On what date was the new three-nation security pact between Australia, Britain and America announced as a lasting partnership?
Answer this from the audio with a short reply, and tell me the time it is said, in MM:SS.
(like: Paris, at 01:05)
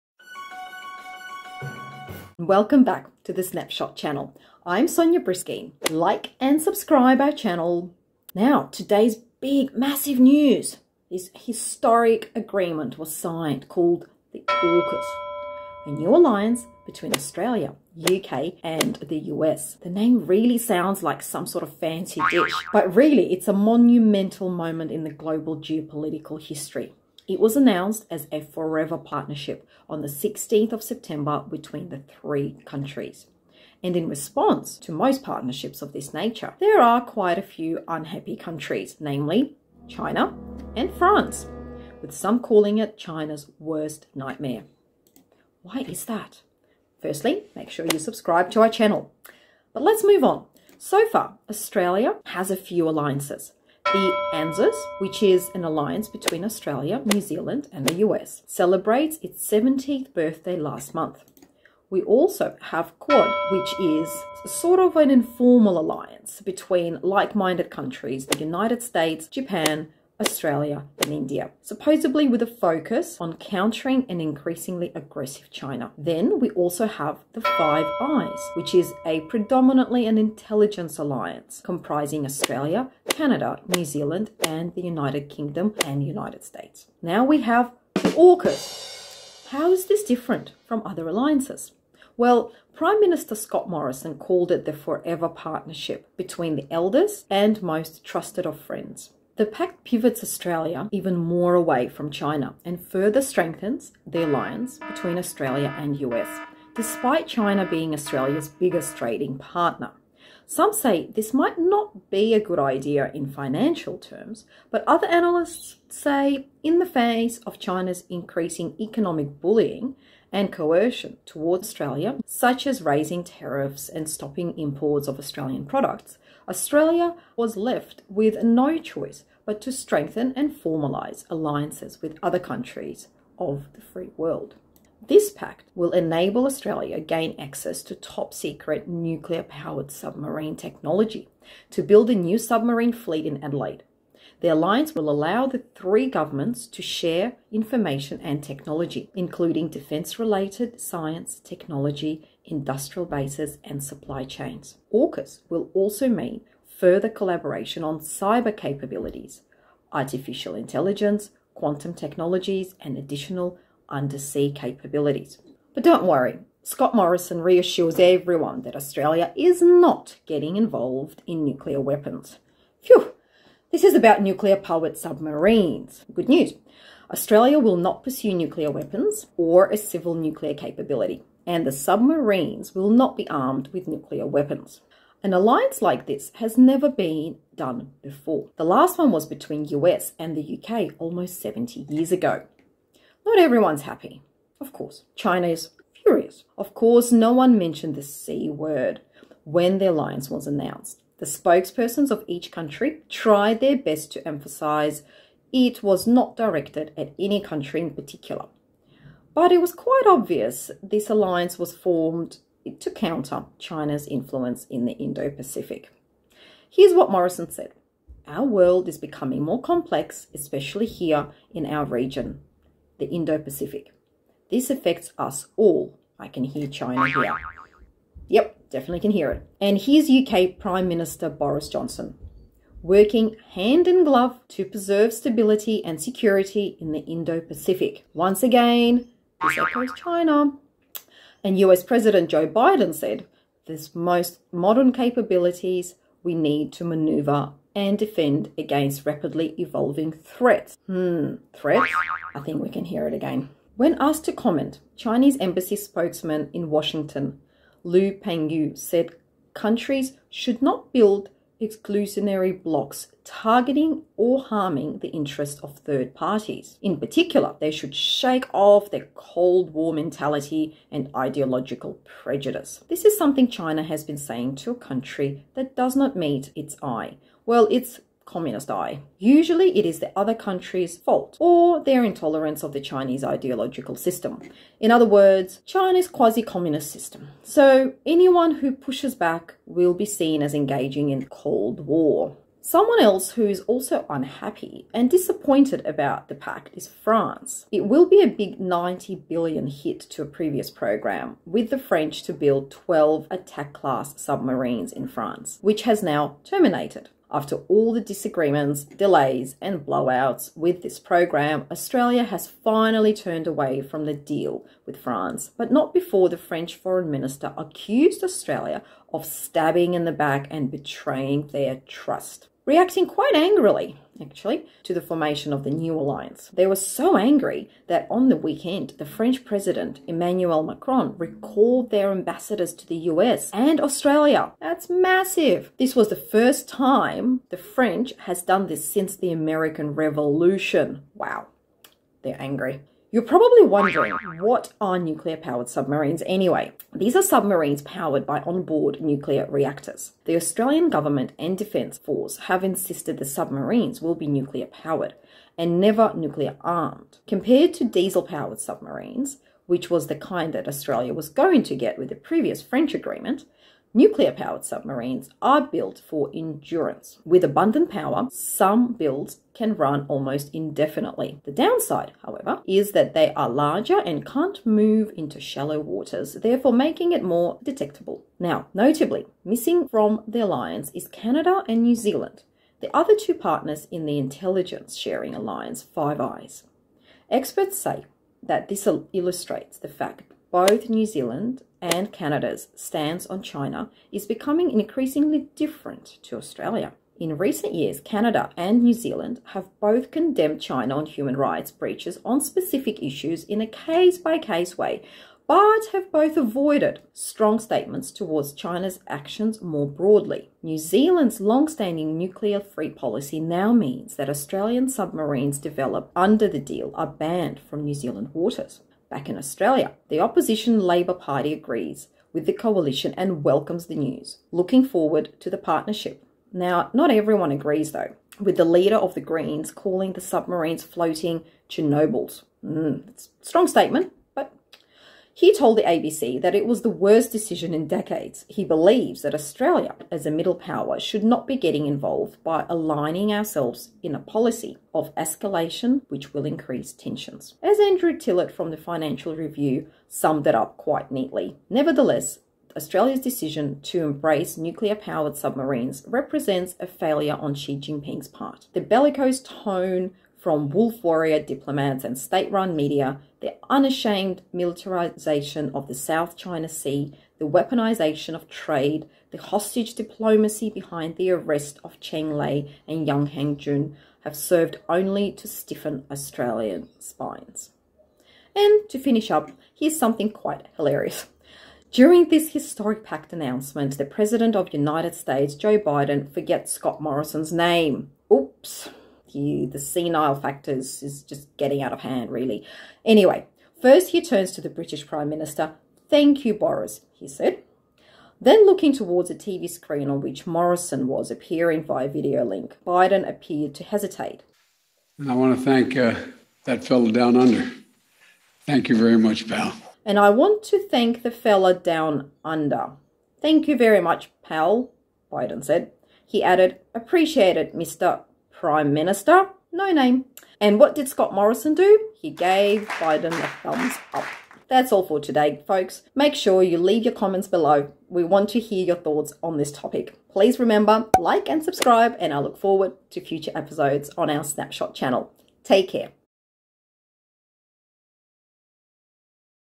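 16 September, at 00:30.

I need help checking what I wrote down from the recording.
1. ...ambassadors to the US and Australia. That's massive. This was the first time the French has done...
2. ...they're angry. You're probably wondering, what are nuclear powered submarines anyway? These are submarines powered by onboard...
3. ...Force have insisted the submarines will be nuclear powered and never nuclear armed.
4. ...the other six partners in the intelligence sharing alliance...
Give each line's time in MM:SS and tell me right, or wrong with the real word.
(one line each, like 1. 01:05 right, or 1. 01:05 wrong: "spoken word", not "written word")
1. 05:32 right
2. 05:42 right
3. 05:51 right
4. 06:22 wrong: "two", not "six".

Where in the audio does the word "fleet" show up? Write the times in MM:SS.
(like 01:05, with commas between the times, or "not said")
02:22.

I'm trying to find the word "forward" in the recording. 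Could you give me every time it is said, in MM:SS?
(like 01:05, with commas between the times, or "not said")
07:04, 08:52.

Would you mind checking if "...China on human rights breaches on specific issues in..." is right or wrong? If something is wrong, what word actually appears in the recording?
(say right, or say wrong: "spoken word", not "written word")
right.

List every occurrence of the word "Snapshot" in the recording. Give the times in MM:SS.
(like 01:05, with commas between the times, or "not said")
00:03, 08:54.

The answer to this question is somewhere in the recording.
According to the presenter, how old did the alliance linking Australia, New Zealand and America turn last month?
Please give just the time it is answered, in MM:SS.
00:59.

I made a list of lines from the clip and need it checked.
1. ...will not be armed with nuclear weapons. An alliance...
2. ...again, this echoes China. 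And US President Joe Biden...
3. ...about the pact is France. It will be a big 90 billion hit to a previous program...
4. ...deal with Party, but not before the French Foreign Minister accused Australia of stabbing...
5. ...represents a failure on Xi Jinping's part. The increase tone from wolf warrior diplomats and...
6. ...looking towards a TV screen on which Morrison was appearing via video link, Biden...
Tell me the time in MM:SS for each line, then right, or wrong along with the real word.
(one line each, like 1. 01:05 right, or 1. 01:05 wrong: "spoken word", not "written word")
1. 03:02 right
2. 03:58 right
3. 04:55 right
4. 05:14 wrong: "France", not "Party"
5. 07:36 wrong: "bellicose", not "increase"
6. 08:18 right.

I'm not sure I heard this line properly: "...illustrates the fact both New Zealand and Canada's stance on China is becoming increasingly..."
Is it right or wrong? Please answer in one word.
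right.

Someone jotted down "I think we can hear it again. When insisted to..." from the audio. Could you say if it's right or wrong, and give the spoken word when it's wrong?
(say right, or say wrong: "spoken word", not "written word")
wrong: "asked", not "insisted".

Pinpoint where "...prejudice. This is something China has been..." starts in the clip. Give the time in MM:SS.
04:32.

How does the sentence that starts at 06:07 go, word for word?
With abundant power, some builds can run almost indefinitely.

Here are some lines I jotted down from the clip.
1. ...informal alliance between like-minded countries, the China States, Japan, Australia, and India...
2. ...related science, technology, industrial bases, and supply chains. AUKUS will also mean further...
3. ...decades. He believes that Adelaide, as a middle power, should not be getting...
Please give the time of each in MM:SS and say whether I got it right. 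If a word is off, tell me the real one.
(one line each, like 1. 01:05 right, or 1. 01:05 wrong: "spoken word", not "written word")
1. 01:05 wrong: "United", not "China"
2. 02:30 right
3. 07:17 wrong: "Australia", not "Adelaide".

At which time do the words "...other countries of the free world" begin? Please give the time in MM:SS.
02:12.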